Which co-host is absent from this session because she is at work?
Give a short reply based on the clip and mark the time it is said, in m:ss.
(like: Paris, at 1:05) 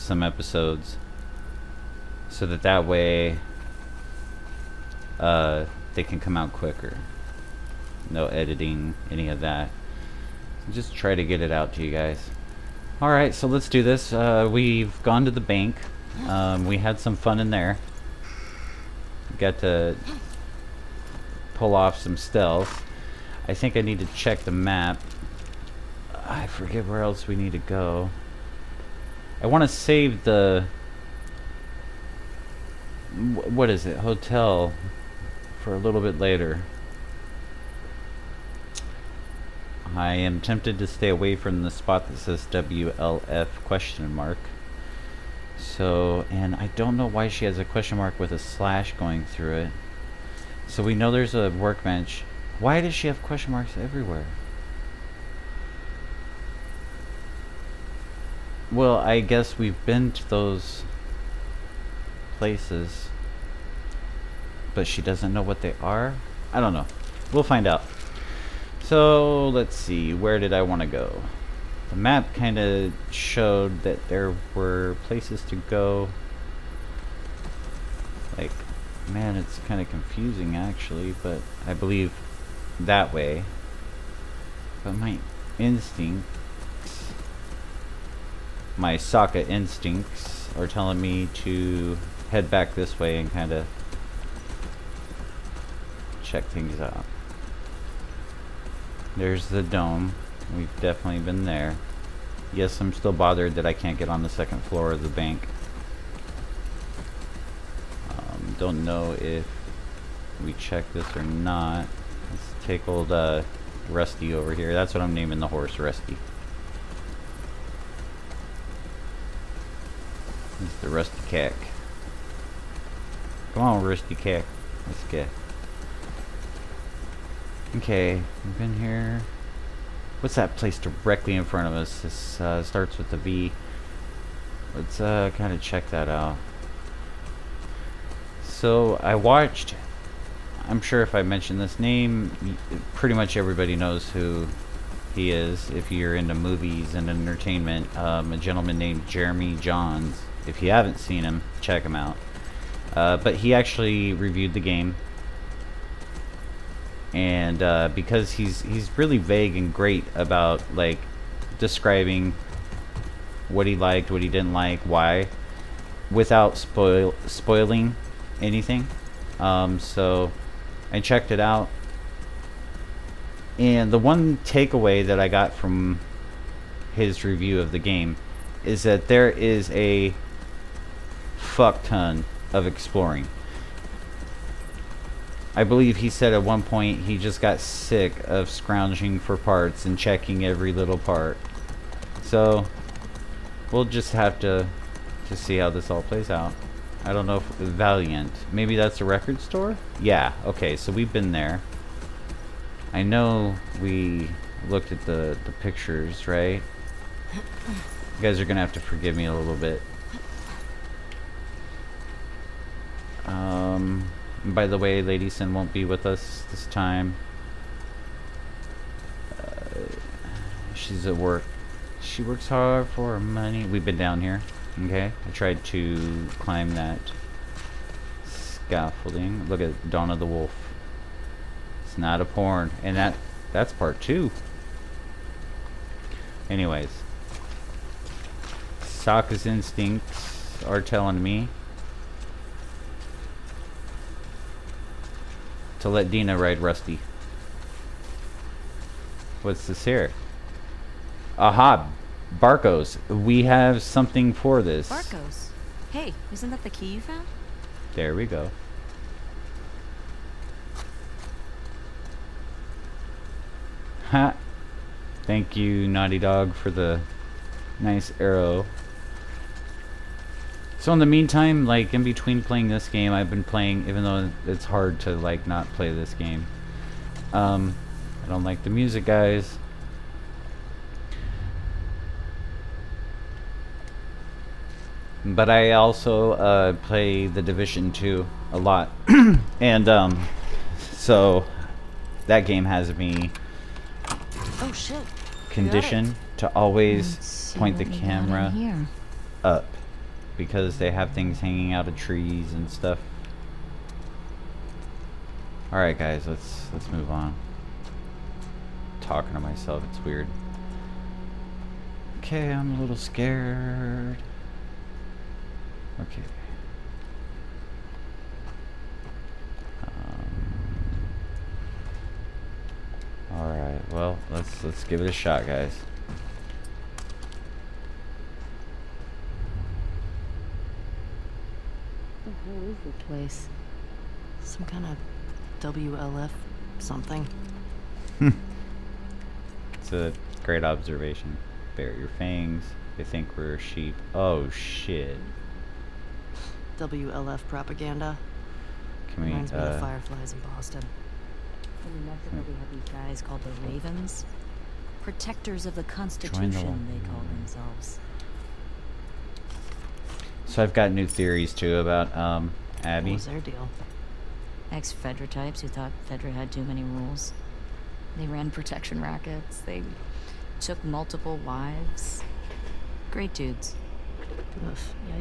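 Lady Sin, at 3:35.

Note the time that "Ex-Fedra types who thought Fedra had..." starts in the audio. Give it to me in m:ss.
6:04.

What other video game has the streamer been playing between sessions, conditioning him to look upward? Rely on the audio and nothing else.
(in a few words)
The Division 2.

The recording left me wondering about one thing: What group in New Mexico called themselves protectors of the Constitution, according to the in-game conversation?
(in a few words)
the Ravens.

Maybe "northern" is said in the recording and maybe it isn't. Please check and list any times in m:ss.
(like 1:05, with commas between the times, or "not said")
not said.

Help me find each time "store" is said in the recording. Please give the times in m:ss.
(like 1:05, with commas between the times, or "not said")
3:19.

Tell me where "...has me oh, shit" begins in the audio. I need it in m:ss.
4:52.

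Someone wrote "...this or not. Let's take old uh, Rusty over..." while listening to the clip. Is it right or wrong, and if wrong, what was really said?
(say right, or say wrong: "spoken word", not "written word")
right.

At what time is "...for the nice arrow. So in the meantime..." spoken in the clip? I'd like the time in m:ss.
4:26.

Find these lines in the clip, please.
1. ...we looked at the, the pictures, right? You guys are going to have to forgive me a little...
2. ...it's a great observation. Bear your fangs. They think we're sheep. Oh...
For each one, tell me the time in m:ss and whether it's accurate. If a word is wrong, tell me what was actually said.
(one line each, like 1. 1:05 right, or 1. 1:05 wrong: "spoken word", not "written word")
1. 3:23 right
2. 5:38 right.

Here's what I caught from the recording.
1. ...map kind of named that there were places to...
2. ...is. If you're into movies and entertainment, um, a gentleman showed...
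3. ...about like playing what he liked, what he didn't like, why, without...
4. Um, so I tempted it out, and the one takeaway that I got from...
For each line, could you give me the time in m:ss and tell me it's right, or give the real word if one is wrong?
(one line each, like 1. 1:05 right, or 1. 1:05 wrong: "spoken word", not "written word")
1. 1:11 wrong: "showed", not "named"
2. 2:25 wrong: "named", not "showed"
3. 2:40 wrong: "describing", not "playing"
4. 2:49 wrong: "checked", not "tempted".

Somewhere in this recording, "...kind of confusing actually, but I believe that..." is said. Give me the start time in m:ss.
1:19.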